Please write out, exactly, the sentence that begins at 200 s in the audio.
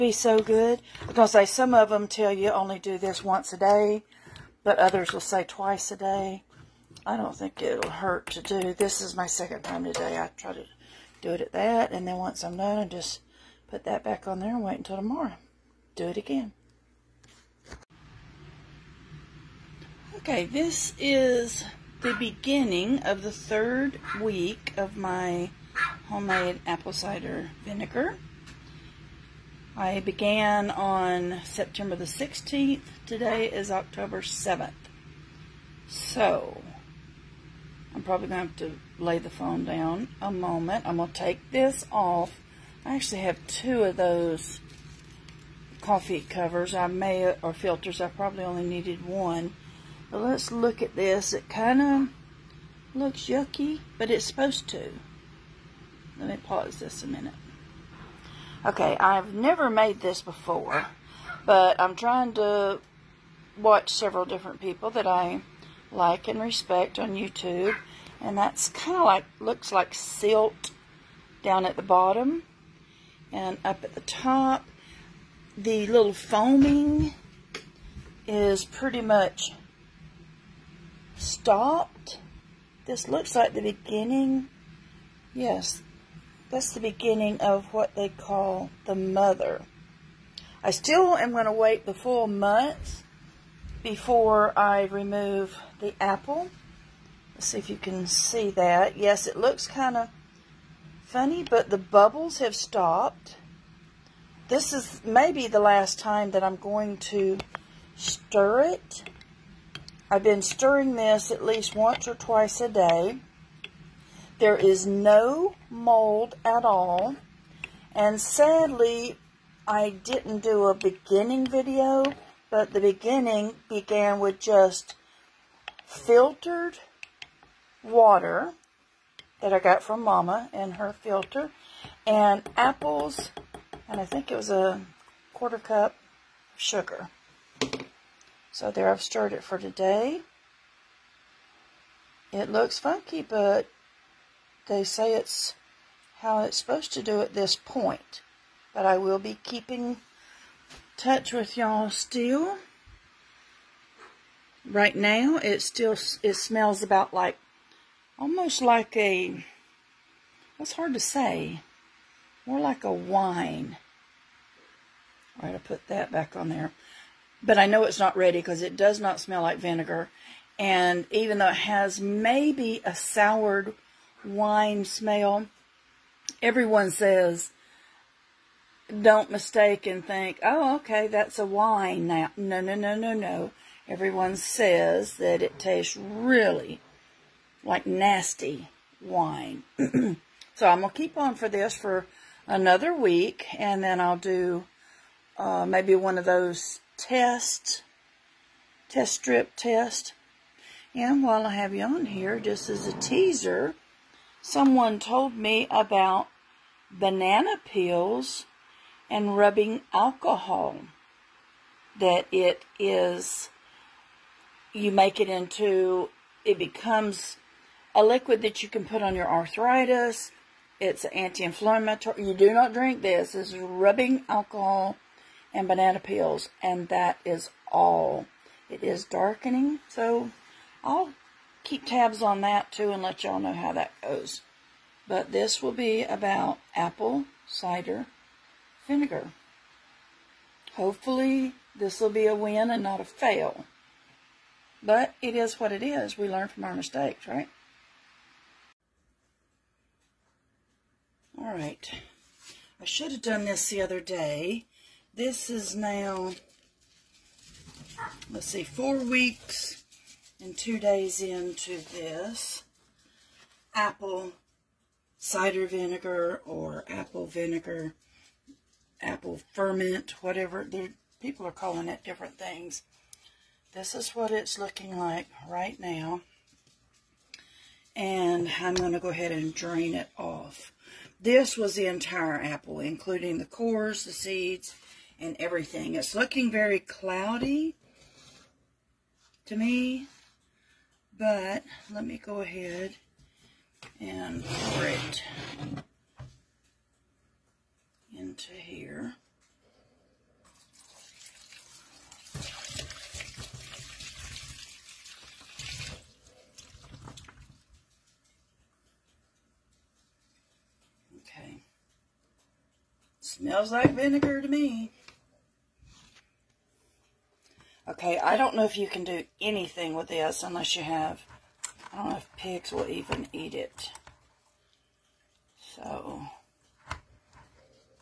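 And while I have you on here, just as a teaser, someone told me about banana peels and rubbing alcohol.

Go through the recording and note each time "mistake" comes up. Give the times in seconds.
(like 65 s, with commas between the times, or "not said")
179 s, 246 s.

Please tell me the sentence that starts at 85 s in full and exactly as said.
Yes, that's the beginning of what they call the mother.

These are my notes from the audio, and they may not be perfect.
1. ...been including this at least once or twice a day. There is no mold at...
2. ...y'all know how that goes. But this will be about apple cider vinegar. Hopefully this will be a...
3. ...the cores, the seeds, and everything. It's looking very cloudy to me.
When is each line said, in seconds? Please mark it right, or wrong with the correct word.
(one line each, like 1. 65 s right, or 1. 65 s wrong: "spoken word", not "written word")
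1. 110 s wrong: "stirring", not "including"
2. 233 s right
3. 283 s right.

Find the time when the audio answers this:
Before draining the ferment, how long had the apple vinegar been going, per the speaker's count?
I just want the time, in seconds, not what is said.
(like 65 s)
258 s.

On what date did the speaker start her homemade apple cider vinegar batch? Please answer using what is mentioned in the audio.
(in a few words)
September 16th.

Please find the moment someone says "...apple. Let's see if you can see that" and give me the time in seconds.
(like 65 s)
95 s.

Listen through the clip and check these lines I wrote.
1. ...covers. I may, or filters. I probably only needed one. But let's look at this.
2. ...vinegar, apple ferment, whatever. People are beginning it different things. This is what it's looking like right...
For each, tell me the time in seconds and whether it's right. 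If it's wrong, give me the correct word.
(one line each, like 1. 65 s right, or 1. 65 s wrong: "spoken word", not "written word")
1. 46 s right
2. 267 s wrong: "calling", not "beginning".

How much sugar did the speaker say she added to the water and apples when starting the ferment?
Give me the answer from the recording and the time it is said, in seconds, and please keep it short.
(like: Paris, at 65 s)
a quarter cup, at 134 s.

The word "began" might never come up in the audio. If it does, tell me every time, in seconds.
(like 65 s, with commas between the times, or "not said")
29 s, 123 s.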